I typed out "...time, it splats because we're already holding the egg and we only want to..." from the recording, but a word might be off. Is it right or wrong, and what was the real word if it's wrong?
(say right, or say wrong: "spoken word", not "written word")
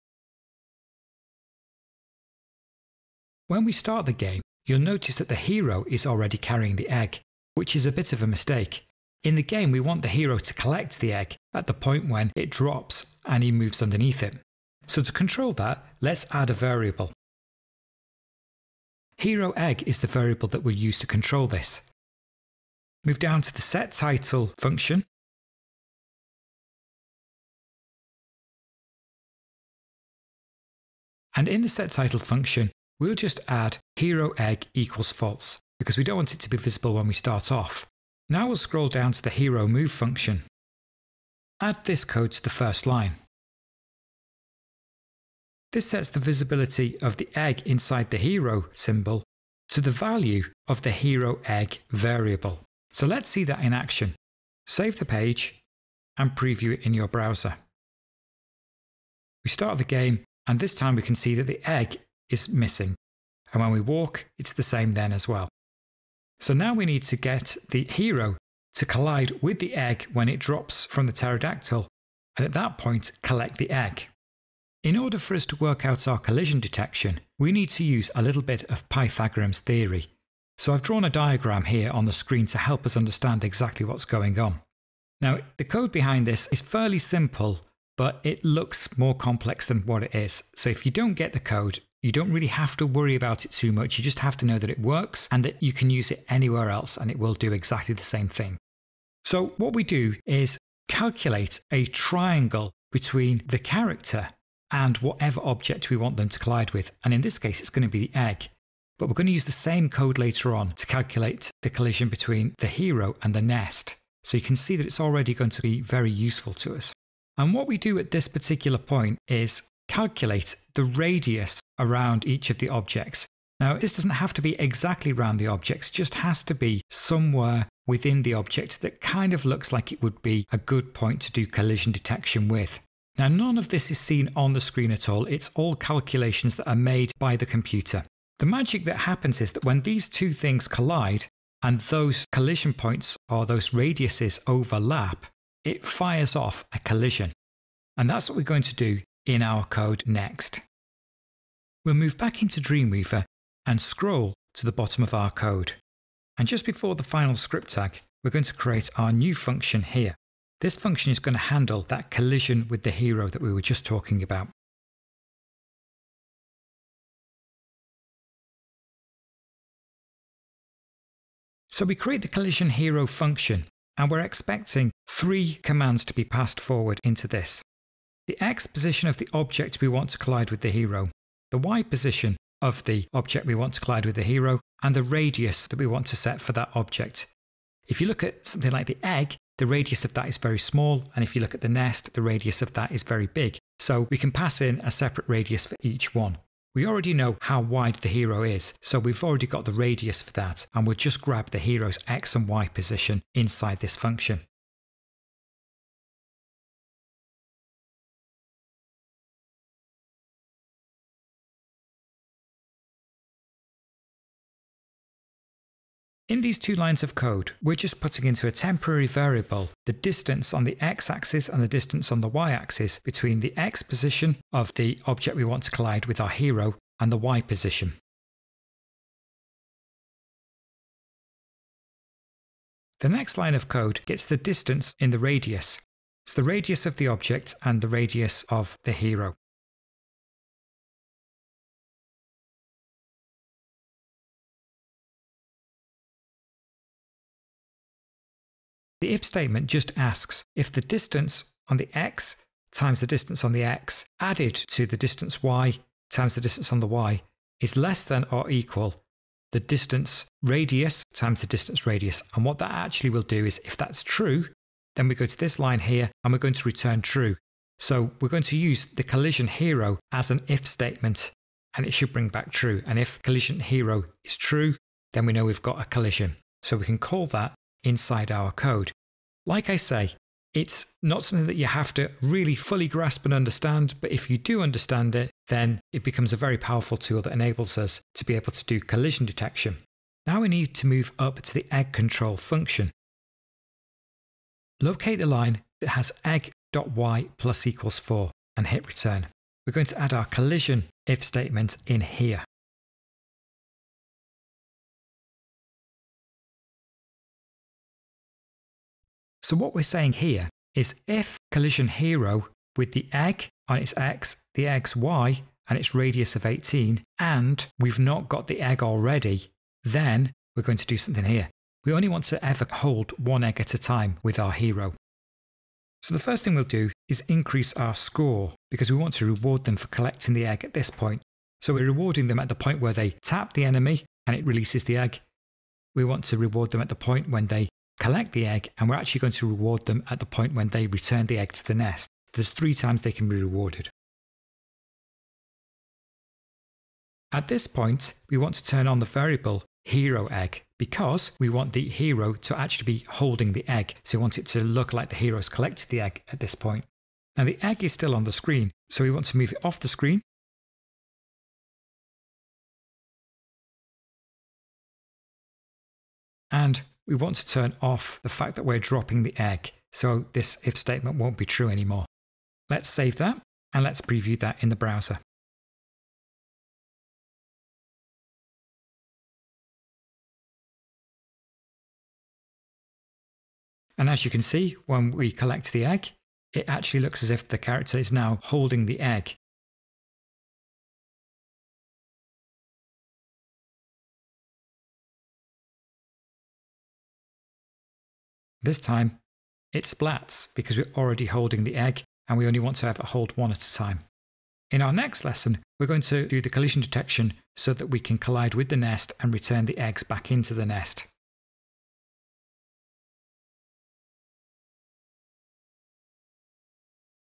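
right.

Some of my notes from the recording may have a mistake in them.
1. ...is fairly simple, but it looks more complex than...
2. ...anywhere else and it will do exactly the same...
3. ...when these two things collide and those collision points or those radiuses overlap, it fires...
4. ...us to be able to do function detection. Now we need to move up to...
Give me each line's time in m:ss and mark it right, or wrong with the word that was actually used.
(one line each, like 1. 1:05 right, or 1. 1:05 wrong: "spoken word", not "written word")
1. 1:26 right
2. 1:36 right
3. 2:19 right
4. 4:47 wrong: "collision", not "function".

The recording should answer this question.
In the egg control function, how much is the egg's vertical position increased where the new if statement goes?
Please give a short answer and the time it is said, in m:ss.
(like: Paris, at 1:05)
4, at 4:56.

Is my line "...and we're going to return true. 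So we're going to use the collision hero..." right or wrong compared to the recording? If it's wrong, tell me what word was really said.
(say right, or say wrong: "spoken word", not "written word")
right.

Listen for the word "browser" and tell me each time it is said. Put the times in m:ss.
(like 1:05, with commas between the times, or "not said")
0:57, 6:14.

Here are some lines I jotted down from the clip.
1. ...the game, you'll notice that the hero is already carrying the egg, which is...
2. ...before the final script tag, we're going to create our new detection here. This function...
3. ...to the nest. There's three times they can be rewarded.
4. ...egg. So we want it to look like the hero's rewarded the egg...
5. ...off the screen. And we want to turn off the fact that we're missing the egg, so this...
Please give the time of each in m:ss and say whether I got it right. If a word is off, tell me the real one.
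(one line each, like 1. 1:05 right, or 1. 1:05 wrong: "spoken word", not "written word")
1. 0:04 right
2. 2:36 wrong: "function", not "detection"
3. 5:41 right
4. 5:53 wrong: "collected", not "rewarded"
5. 5:59 wrong: "dropping", not "missing".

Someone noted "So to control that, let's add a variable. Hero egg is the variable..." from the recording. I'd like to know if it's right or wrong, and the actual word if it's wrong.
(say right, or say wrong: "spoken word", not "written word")
right.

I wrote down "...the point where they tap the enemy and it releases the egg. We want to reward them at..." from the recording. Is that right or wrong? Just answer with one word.
right.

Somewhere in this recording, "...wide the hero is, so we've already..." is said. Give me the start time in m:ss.
3:17.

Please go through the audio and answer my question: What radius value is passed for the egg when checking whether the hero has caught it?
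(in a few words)
18.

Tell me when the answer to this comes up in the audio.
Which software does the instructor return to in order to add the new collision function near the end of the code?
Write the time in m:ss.
2:32.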